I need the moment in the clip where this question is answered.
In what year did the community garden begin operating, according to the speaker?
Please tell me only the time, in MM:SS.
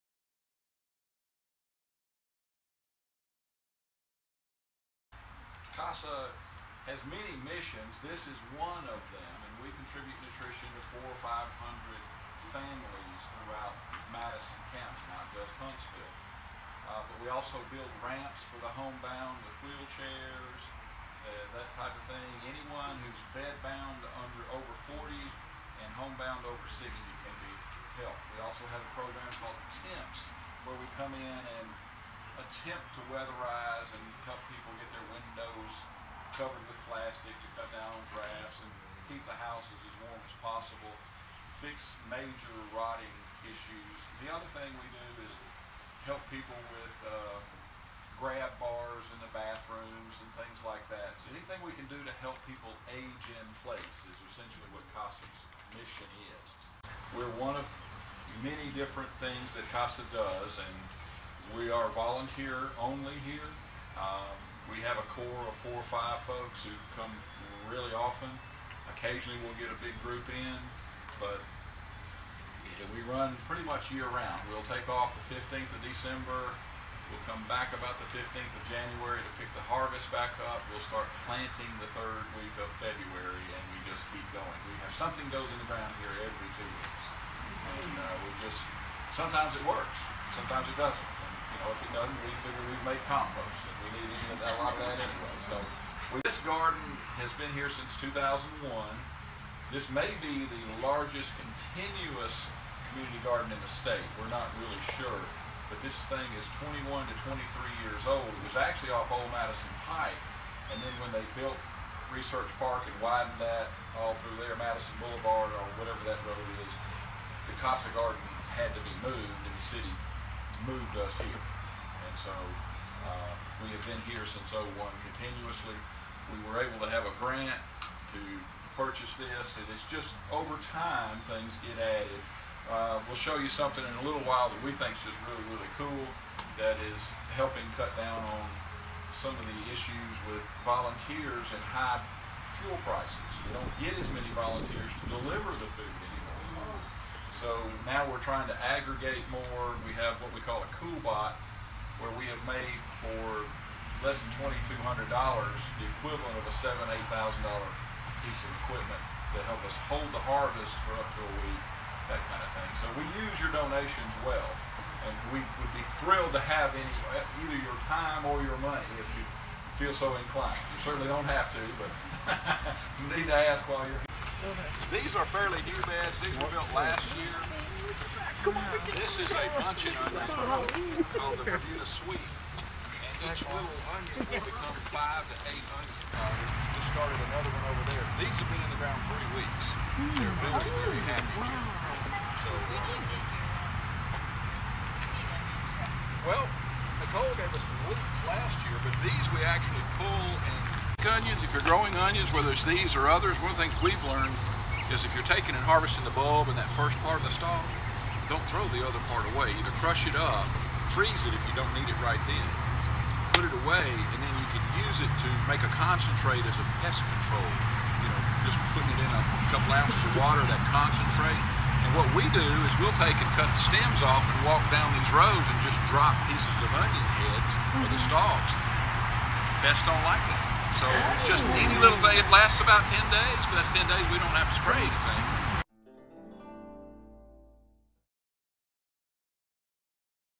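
01:38.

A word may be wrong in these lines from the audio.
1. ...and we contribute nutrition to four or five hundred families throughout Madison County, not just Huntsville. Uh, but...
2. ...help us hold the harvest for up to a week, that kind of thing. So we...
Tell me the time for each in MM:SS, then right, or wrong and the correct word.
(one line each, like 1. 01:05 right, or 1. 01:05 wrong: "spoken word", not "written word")
1. 00:09 right
2. 02:39 right.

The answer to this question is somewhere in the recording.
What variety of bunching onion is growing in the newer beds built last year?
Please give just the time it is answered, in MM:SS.
03:01.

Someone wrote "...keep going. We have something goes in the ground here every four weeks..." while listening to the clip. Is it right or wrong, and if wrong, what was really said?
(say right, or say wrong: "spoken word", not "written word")
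wrong: "two", not "four".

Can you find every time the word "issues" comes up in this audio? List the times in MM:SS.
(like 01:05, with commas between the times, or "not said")
00:43, 02:19.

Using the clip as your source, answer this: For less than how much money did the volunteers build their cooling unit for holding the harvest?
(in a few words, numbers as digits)
$2,200.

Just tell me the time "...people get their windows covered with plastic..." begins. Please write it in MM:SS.
00:34.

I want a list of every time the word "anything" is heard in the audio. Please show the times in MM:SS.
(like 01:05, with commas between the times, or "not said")
00:51, 03:54.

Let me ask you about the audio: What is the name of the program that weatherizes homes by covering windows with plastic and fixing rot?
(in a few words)
TEMPS.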